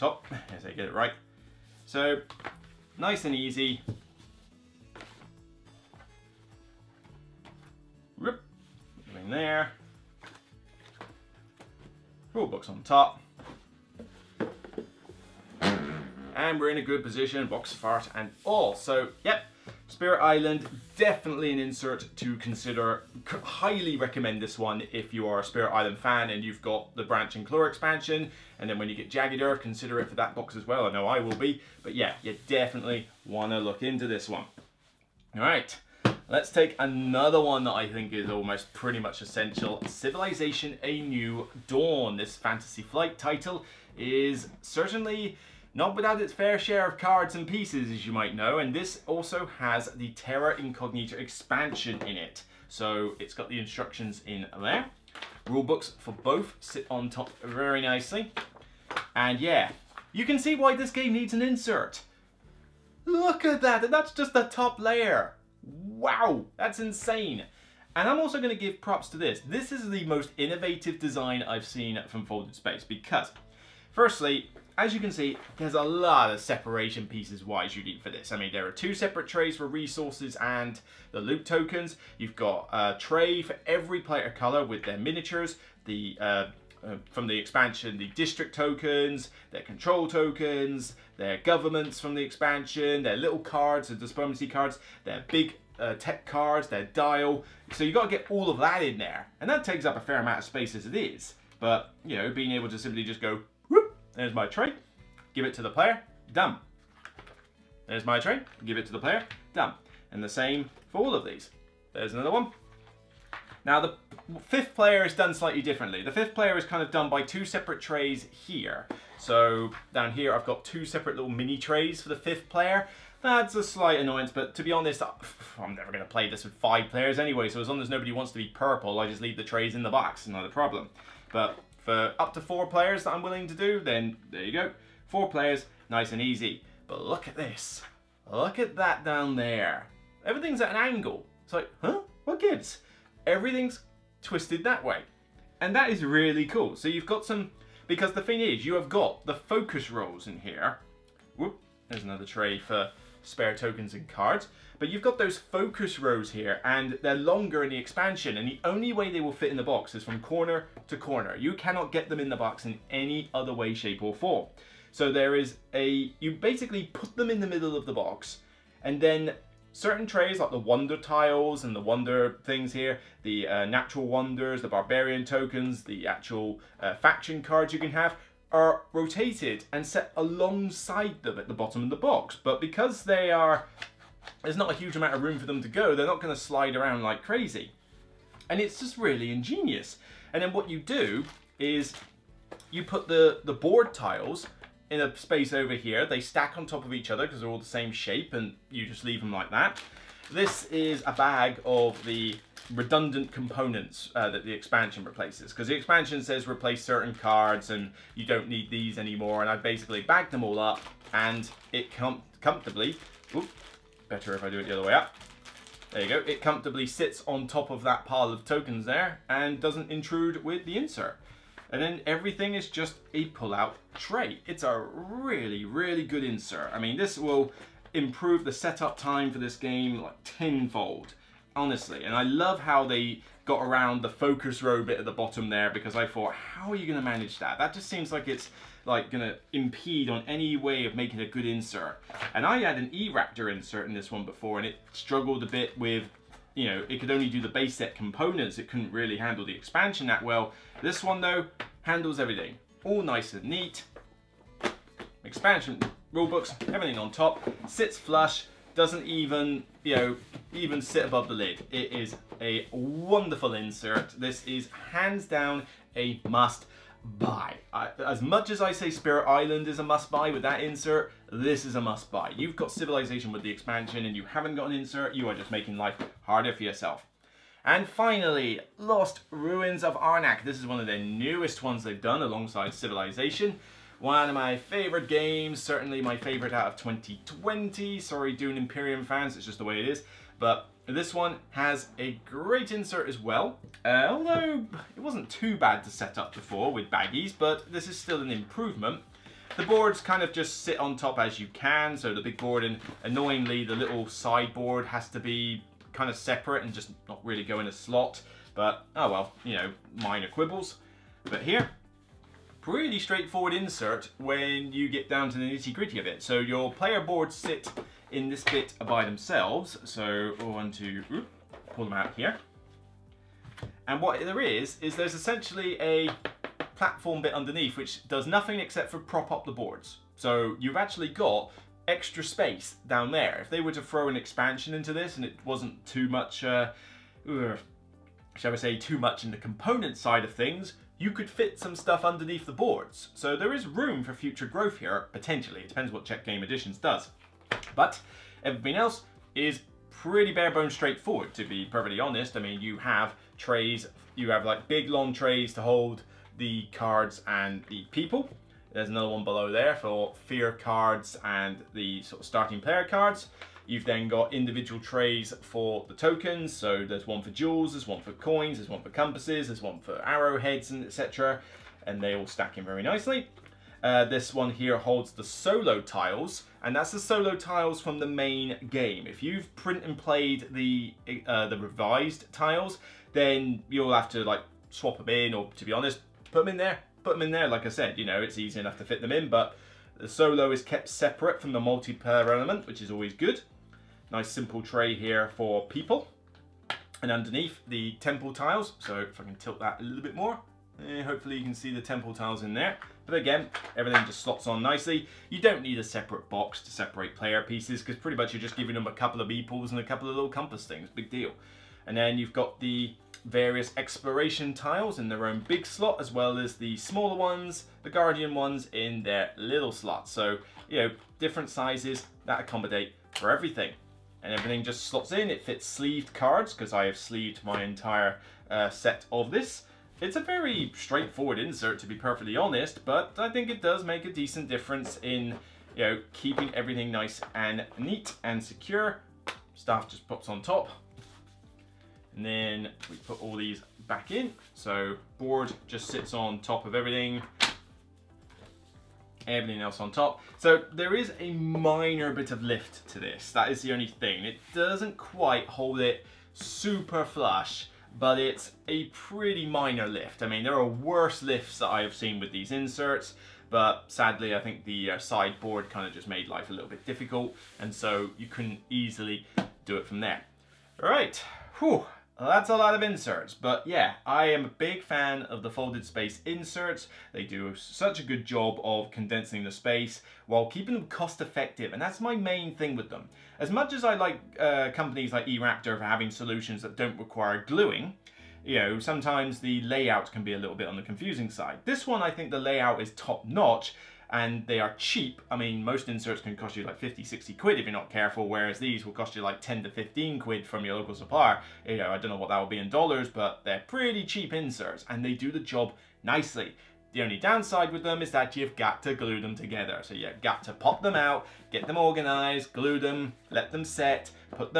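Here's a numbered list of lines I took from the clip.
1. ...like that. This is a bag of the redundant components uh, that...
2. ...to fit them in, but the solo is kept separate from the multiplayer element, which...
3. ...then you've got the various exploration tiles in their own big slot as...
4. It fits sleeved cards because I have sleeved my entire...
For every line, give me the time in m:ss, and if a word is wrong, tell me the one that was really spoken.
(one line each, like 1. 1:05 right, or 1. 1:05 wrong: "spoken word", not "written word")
1. 3:19 right
2. 6:28 right
3. 6:51 right
4. 7:05 right.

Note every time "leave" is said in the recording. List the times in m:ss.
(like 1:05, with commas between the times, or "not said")
2:09, 3:19.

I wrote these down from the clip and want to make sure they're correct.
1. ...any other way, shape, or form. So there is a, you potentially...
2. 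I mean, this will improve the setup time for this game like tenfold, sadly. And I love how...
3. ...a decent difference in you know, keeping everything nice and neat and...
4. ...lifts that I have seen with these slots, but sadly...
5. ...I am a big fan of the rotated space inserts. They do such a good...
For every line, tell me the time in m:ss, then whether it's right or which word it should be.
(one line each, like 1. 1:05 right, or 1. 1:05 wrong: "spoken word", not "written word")
1. 2:42 wrong: "basically", not "potentially"
2. 3:46 wrong: "honestly", not "sadly"
3. 7:14 right
4. 7:41 wrong: "inserts", not "slots"
5. 7:54 wrong: "folded", not "rotated".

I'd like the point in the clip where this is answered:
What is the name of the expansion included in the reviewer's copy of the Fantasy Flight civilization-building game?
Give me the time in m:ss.
0:50.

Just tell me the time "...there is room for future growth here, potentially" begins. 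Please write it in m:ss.
5:43.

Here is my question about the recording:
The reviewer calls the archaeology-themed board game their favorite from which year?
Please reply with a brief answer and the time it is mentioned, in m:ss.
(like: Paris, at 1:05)
2020, at 4:46.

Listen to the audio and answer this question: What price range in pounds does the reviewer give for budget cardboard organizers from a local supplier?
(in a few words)
10 to 15 quid.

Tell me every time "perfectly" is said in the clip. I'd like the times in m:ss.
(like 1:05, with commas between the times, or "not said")
5:51, 7:11.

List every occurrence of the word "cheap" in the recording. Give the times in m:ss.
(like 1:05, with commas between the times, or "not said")
8:14, 8:24.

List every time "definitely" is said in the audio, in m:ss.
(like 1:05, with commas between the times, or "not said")
0:20, 0:32.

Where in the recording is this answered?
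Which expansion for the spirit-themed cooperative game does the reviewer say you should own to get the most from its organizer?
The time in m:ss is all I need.
0:27.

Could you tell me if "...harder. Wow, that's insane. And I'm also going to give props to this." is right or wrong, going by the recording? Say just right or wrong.
wrong.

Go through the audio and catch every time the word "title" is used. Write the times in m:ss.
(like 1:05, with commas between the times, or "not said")
0:43.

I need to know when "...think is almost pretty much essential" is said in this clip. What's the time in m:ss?
0:37.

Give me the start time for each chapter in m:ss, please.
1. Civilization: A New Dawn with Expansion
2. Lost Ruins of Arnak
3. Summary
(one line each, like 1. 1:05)
1. 0:35
2. 4:37
3. 7:49.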